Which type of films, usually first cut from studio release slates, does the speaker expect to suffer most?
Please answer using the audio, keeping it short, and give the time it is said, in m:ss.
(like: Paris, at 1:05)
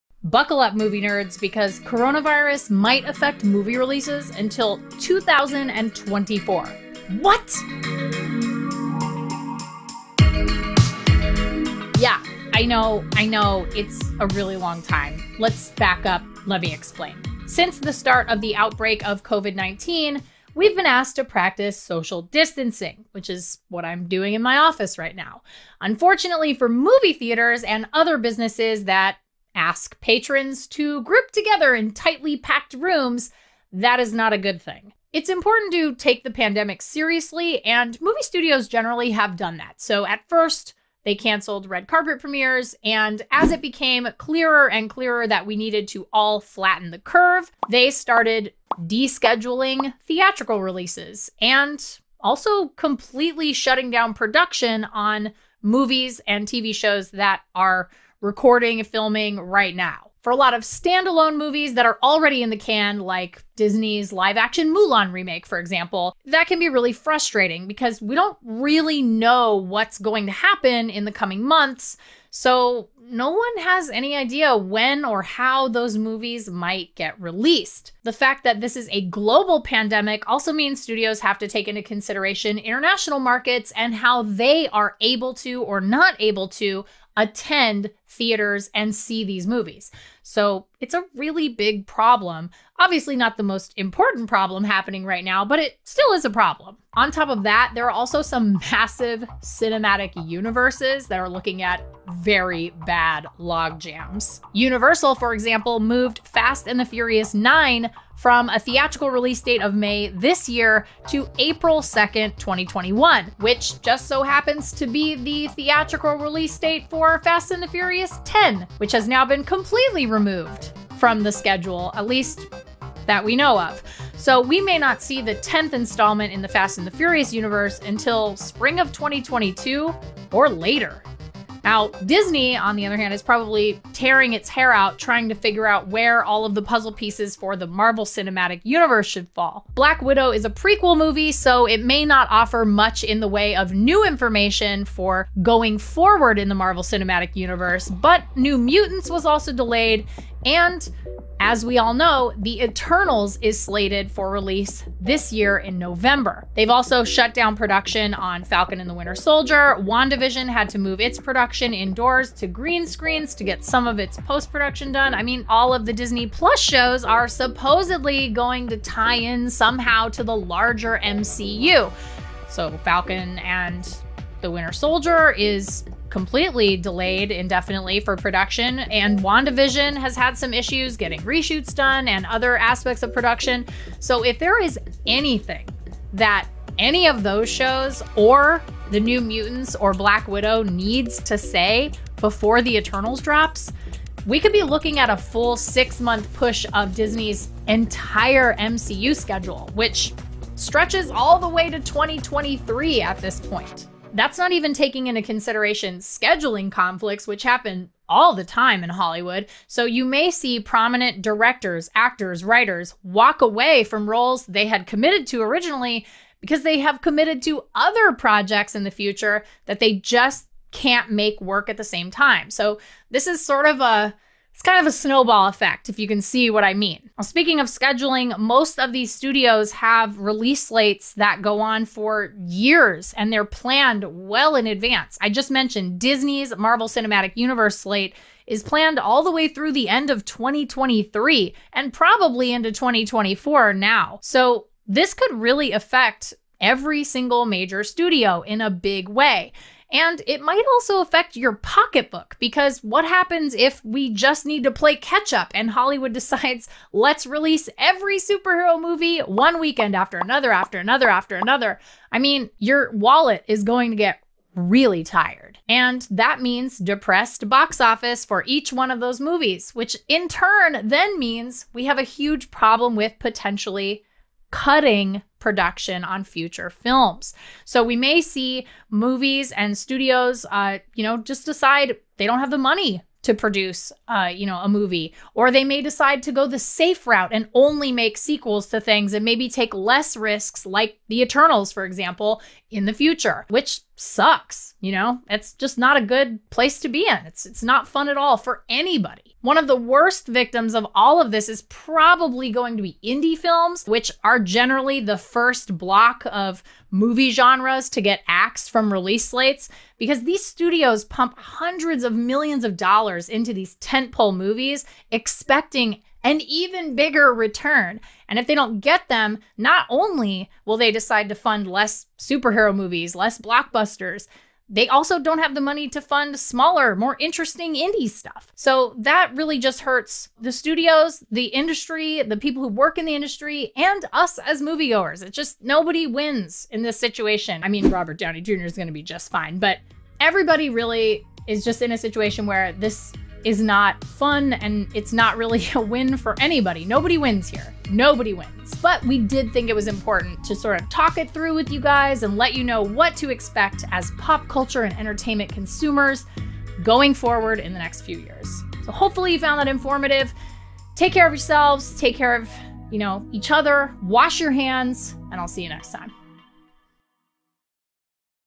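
indie films, at 5:03.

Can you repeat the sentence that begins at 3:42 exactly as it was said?
So this is sort of a it's kind of a snowball effect, if you can see what I mean.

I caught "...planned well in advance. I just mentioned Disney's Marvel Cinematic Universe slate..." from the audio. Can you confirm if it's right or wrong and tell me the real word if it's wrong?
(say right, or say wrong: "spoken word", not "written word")
right.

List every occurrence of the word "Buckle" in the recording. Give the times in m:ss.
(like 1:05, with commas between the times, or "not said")
0:00.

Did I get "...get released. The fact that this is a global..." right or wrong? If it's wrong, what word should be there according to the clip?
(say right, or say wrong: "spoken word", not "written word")
right.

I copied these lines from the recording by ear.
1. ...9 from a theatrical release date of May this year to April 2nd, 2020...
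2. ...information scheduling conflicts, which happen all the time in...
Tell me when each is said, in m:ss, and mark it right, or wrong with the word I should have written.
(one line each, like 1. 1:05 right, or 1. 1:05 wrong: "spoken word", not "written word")
1. 1:47 wrong: "2021", not "2020"
2. 3:25 wrong: "consideration", not "information".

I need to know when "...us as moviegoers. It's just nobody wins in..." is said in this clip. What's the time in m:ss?
5:34.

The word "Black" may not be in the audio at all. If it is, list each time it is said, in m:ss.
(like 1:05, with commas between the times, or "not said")
2:19, 3:09.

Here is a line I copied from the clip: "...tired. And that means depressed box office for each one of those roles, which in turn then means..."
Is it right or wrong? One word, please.
wrong.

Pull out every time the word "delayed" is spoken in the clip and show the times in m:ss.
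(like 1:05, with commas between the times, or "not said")
2:29, 2:56.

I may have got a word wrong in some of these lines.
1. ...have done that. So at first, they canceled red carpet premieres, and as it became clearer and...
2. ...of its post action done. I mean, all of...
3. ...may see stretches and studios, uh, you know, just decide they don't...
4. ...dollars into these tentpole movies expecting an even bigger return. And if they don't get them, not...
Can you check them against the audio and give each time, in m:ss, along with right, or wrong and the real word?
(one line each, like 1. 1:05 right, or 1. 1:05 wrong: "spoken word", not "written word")
1. 0:39 right
2. 2:43 wrong: "production", not "action"
3. 4:37 wrong: "movies", not "stretches"
4. 5:12 right.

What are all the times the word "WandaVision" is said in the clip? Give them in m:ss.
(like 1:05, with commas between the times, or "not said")
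2:39, 2:59.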